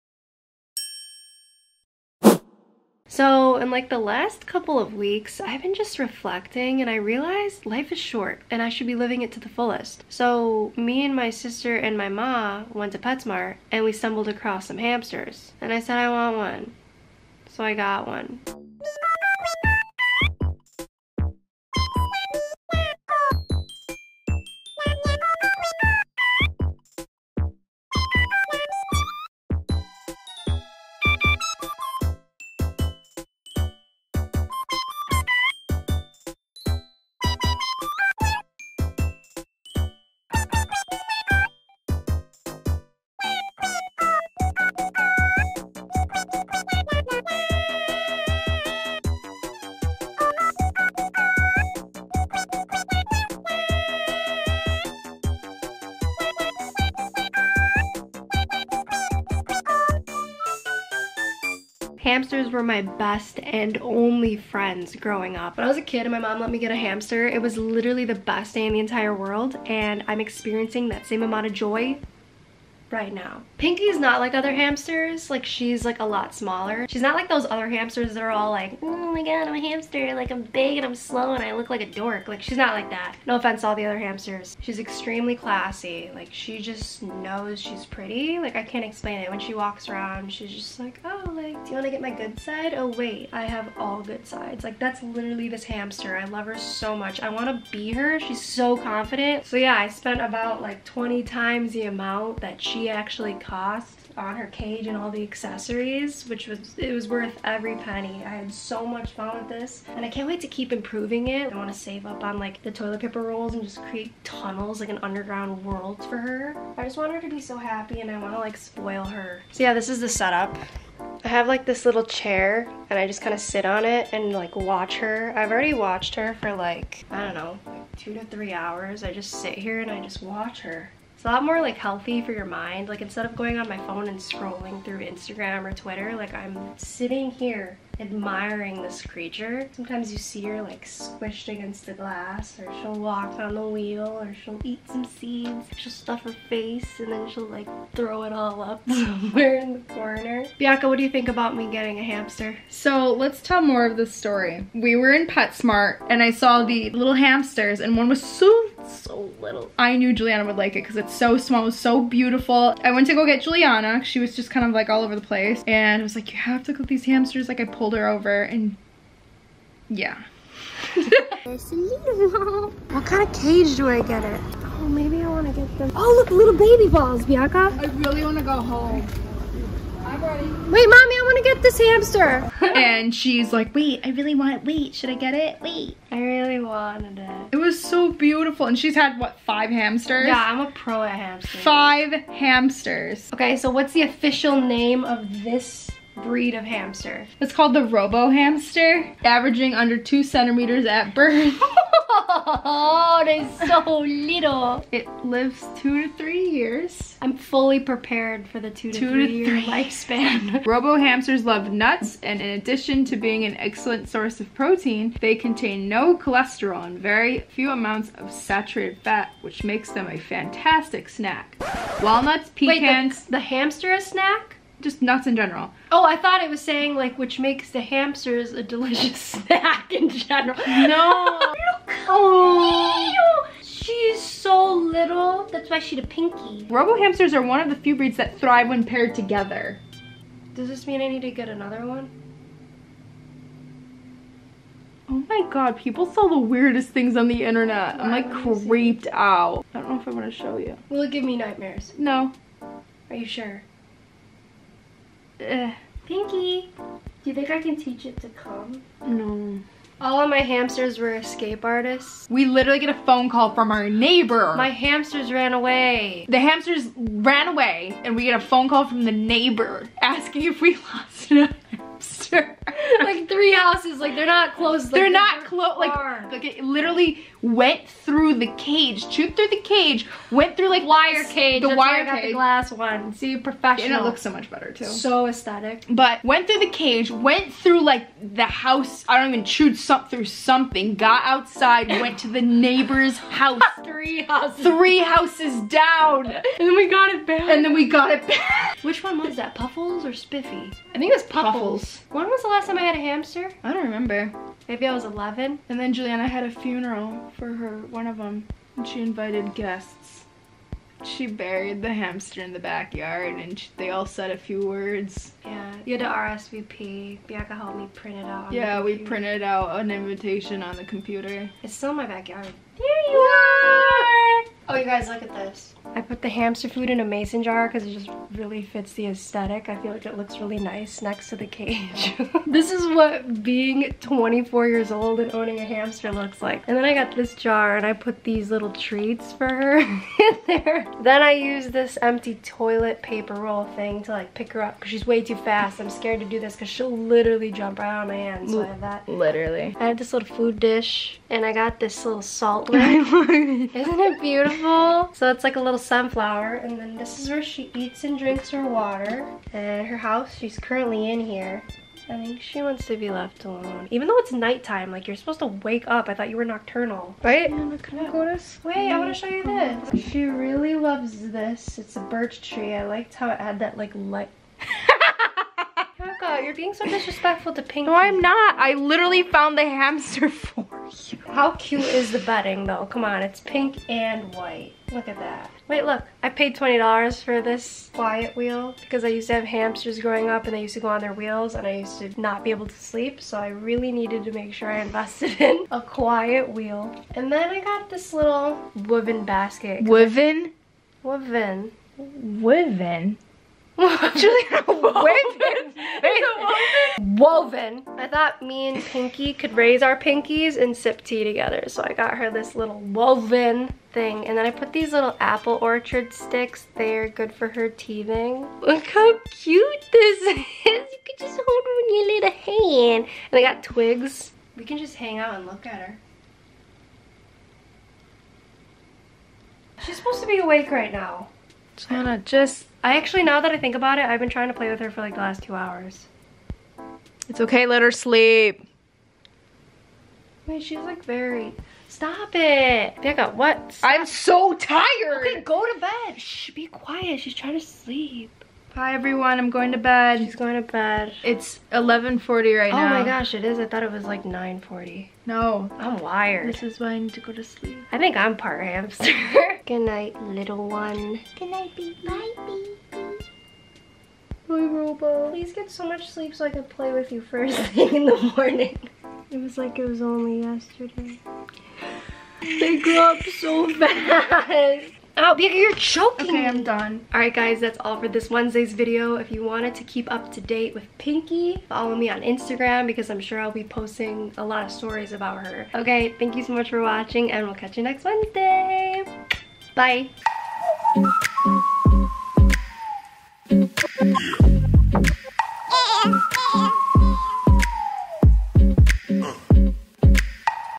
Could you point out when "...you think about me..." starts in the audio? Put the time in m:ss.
2:31.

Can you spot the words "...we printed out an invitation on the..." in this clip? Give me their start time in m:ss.
5:18.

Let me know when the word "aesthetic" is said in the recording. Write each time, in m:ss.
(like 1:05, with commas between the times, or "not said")
4:45, 5:29.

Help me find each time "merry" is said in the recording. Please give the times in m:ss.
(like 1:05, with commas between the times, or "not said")
not said.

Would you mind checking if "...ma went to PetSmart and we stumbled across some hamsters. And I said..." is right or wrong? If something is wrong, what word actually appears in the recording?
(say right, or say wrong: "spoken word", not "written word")
right.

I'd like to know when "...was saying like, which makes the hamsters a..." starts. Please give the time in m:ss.
3:46.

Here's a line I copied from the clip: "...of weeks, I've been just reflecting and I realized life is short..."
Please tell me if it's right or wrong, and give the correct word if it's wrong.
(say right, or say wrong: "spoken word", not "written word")
right.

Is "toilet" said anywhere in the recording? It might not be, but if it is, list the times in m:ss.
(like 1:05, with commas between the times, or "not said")
1:52, 5:42.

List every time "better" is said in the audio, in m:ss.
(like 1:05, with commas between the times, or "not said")
4:44.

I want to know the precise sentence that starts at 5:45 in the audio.
I'm scared to do this because she'll literally jump right on my hands.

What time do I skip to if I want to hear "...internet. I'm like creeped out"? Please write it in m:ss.
4:07.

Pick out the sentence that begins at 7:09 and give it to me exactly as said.
She's supposed to be awake right now.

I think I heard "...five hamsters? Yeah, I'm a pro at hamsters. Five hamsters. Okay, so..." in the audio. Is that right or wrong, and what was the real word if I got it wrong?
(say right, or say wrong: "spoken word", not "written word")
right.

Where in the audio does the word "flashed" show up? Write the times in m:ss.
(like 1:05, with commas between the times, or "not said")
not said.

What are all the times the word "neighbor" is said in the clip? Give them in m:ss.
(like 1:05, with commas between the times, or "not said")
4:23, 4:29, 4:52.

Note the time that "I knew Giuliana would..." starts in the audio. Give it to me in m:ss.
2:39.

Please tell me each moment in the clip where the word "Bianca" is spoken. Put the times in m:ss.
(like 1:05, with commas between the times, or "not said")
2:30, 2:57, 5:17, 7:55.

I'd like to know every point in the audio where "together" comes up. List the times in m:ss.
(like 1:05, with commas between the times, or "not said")
3:59, 6:51.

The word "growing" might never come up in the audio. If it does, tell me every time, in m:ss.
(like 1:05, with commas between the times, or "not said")
1:04, 6:29.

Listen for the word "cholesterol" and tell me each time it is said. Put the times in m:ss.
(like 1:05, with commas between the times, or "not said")
3:36.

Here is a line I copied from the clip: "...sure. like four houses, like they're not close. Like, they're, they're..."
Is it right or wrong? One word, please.
wrong.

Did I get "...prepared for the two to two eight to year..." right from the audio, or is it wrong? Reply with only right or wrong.
wrong.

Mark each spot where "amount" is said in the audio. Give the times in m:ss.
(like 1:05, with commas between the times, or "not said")
1:11, 1:41, 3:37.